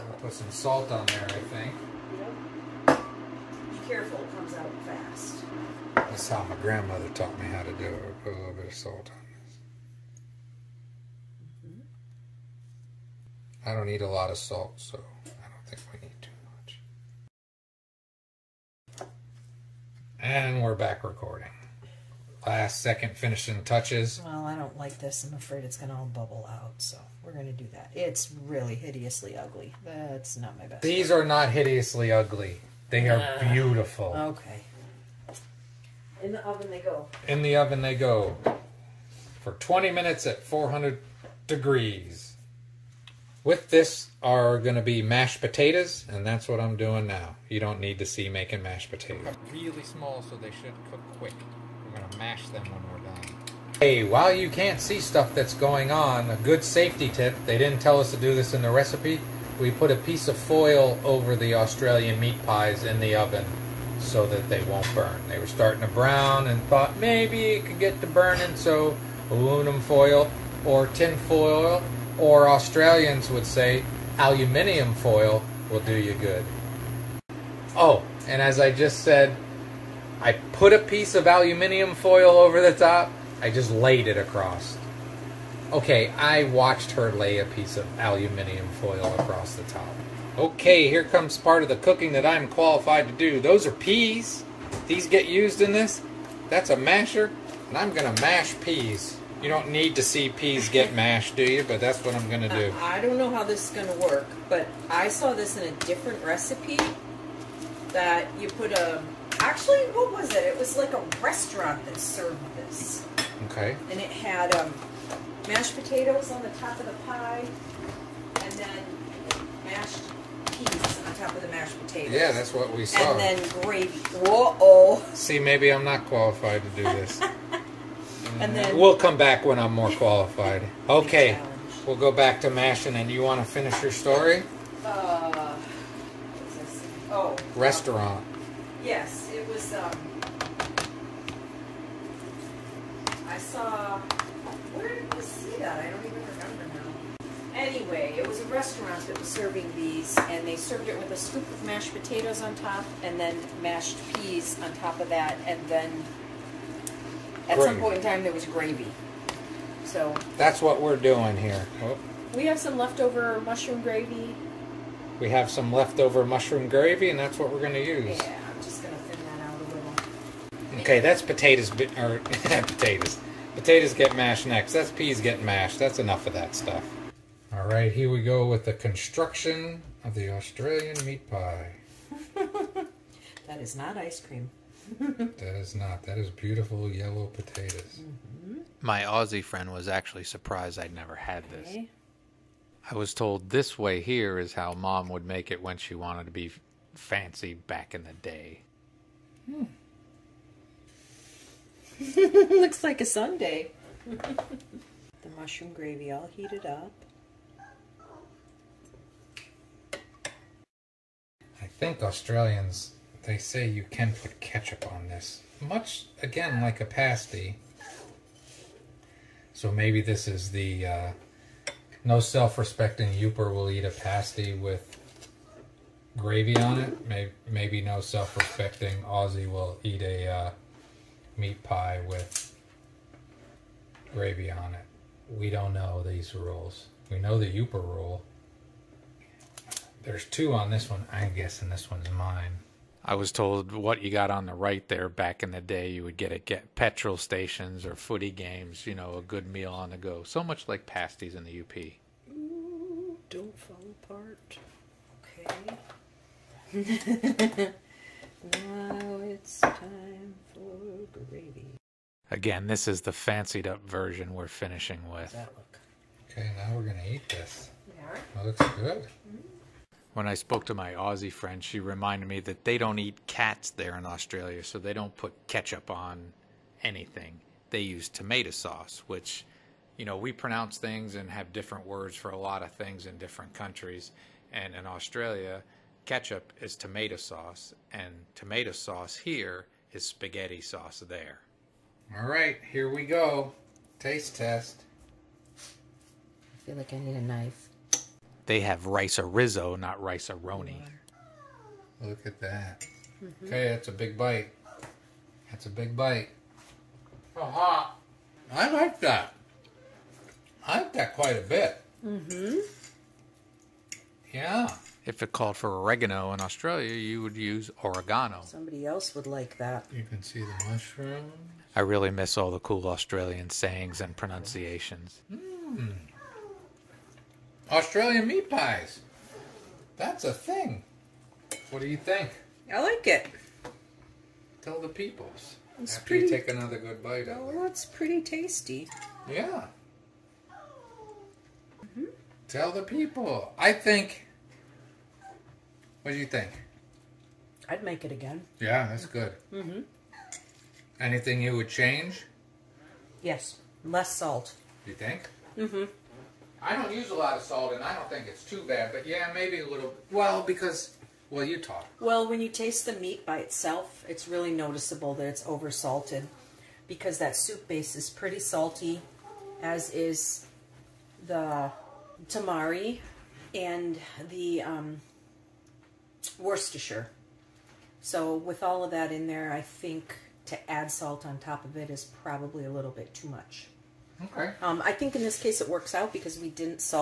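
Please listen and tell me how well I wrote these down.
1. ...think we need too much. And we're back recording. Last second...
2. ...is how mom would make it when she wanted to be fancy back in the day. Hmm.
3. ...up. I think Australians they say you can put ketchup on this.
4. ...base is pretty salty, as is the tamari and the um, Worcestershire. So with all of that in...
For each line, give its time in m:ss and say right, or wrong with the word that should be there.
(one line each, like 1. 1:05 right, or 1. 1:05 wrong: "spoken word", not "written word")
1. 0:15 right
2. 3:14 right
3. 3:26 right
4. 6:07 right.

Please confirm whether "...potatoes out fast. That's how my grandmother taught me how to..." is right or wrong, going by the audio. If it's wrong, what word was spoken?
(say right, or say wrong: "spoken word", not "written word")
wrong: "comes", not "potatoes".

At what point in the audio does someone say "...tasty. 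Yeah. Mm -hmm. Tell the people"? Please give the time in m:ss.
5:38.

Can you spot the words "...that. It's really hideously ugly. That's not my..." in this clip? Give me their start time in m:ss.
0:27.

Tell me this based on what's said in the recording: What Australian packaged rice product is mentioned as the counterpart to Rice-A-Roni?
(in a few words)
Rice arizo.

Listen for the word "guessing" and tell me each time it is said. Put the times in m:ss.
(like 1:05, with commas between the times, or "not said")
4:01.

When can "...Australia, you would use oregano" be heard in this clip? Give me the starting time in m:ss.
5:16.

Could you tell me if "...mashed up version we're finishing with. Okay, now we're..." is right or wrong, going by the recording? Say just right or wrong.
wrong.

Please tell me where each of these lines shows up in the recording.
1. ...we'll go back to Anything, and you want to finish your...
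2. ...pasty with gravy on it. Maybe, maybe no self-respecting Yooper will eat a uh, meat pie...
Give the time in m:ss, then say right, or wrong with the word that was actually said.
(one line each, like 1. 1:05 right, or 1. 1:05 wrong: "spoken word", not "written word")
1. 2:11 wrong: "Mashin", not "Anything"
2. 3:43 wrong: "Aussie", not "Yooper".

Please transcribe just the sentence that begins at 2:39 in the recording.
So That's what we're doing here.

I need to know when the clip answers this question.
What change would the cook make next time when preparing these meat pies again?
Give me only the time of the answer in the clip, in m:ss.
5:53.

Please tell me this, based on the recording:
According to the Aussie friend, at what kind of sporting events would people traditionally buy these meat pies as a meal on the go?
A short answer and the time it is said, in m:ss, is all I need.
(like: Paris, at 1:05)
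Footy games, at 4:07.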